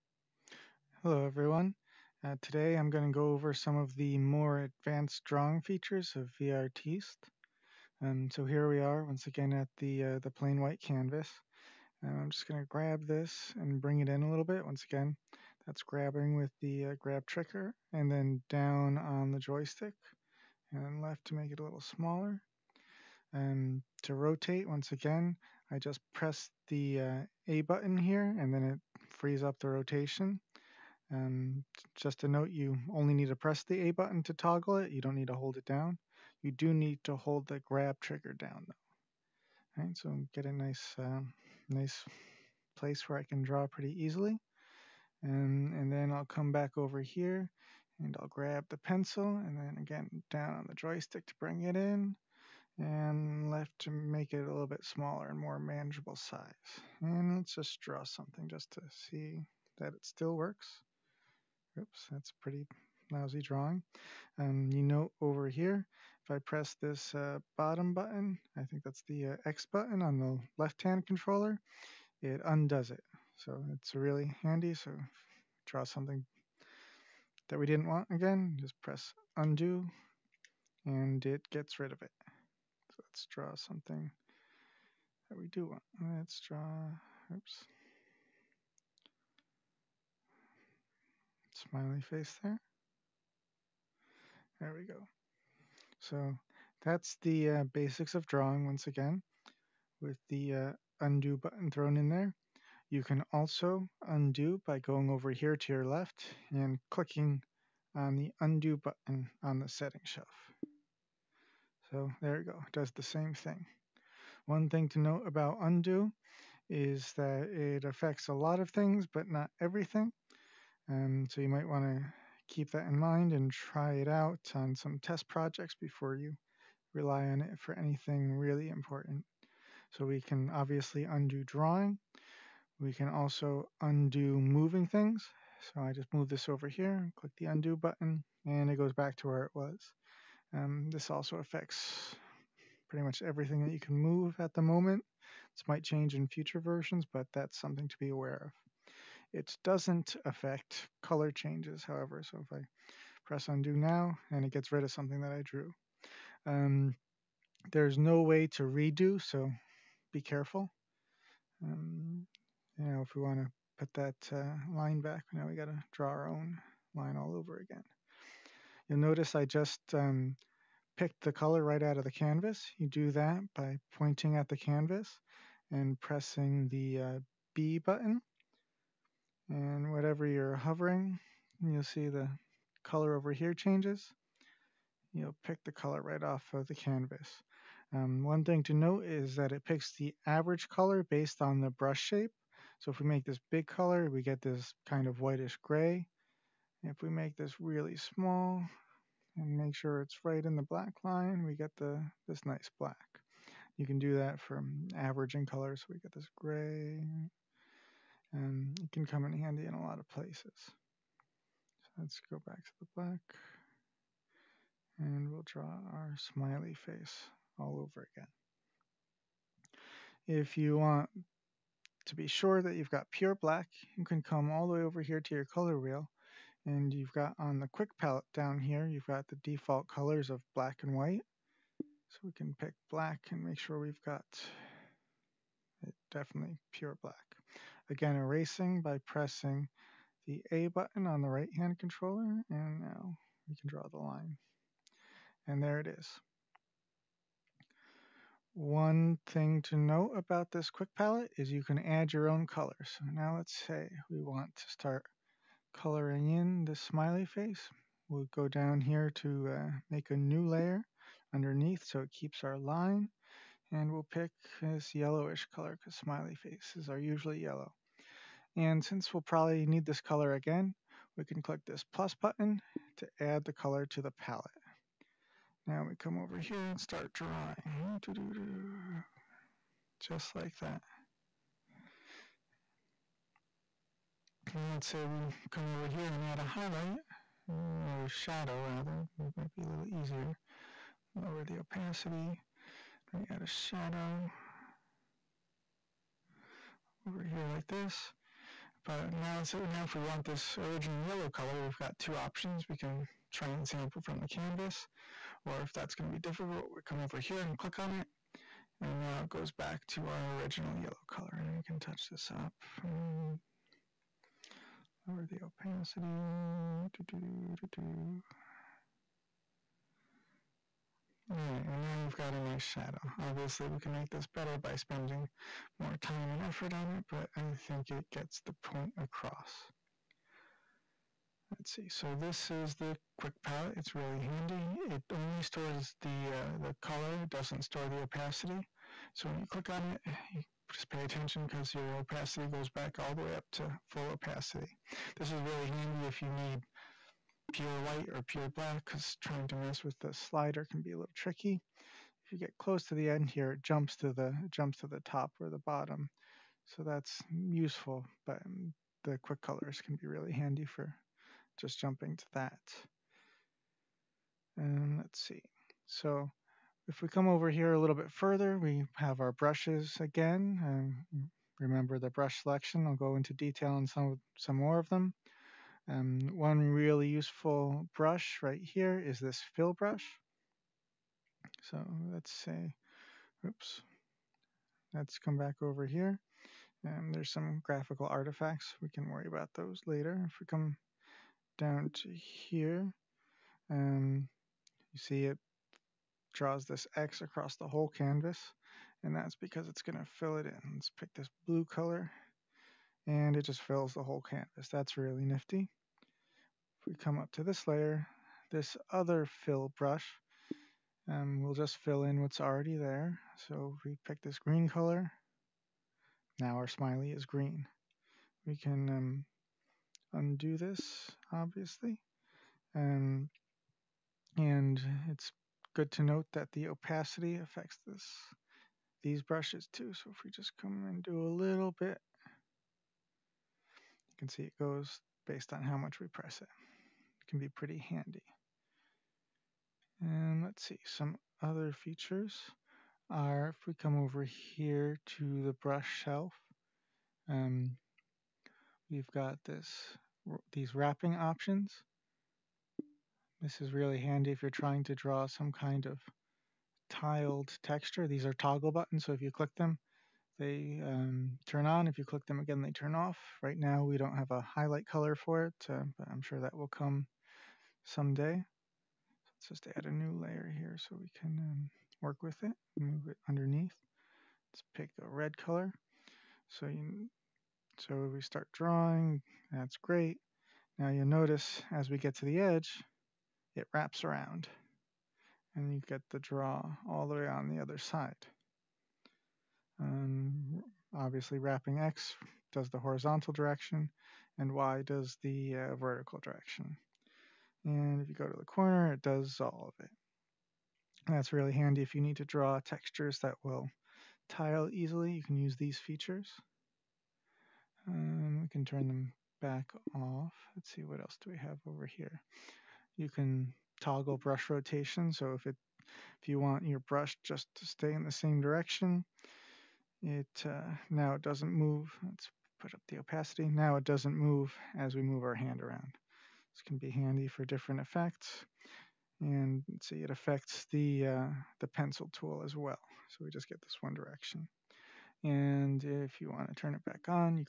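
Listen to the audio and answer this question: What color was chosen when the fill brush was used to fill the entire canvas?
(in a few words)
Blue.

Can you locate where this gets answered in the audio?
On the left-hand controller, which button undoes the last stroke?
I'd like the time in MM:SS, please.
01:09.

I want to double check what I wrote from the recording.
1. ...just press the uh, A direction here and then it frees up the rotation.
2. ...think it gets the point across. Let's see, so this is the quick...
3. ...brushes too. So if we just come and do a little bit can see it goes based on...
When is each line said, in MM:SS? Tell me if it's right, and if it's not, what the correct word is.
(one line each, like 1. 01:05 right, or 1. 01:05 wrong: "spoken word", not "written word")
1. 00:25 wrong: "button", not "direction"
2. 05:27 right
3. 07:09 right.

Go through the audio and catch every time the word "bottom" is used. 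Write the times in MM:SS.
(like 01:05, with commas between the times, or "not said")
01:07, 05:55.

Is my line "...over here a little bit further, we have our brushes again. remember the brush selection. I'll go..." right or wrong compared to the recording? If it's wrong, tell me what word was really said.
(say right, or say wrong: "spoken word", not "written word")
right.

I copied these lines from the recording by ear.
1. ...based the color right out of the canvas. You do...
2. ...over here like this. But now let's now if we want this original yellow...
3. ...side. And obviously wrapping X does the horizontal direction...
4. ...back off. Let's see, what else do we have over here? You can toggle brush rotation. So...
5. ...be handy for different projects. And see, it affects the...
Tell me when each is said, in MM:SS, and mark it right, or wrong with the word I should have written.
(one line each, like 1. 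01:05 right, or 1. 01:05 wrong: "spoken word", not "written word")
1. 02:50 wrong: "picked", not "based"
2. 04:57 right
3. 08:07 right
4. 08:29 right
5. 08:46 wrong: "effects", not "projects".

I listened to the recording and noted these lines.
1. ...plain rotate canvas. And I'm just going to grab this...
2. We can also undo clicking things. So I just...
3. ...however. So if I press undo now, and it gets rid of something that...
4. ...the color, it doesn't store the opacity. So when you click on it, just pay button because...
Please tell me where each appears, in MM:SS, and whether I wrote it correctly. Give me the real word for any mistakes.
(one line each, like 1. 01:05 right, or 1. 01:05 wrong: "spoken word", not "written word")
1. 00:10 wrong: "white", not "rotate"
2. 02:12 wrong: "moving", not "clicking"
3. 02:31 right
4. 05:36 wrong: "attention", not "button".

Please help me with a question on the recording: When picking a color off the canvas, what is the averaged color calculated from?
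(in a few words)
The brush shape.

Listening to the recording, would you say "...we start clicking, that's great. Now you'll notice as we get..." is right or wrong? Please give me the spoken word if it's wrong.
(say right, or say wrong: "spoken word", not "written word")
wrong: "drawing", not "clicking".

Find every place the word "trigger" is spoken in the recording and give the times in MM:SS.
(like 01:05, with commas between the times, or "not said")
00:17, 00:37.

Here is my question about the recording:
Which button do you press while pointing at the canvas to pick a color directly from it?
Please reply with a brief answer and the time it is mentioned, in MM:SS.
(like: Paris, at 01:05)
B button, at 02:57.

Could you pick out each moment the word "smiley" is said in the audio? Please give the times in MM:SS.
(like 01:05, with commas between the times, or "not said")
01:31, 03:36, 04:16, 04:25, 06:56.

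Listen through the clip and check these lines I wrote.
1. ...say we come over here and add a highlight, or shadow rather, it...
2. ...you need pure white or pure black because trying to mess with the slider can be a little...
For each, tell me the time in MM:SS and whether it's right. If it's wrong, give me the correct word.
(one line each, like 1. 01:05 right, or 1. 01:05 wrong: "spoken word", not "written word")
1. 04:44 right
2. 05:46 right.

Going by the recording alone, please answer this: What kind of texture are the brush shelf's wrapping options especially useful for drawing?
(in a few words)
Tiled texture.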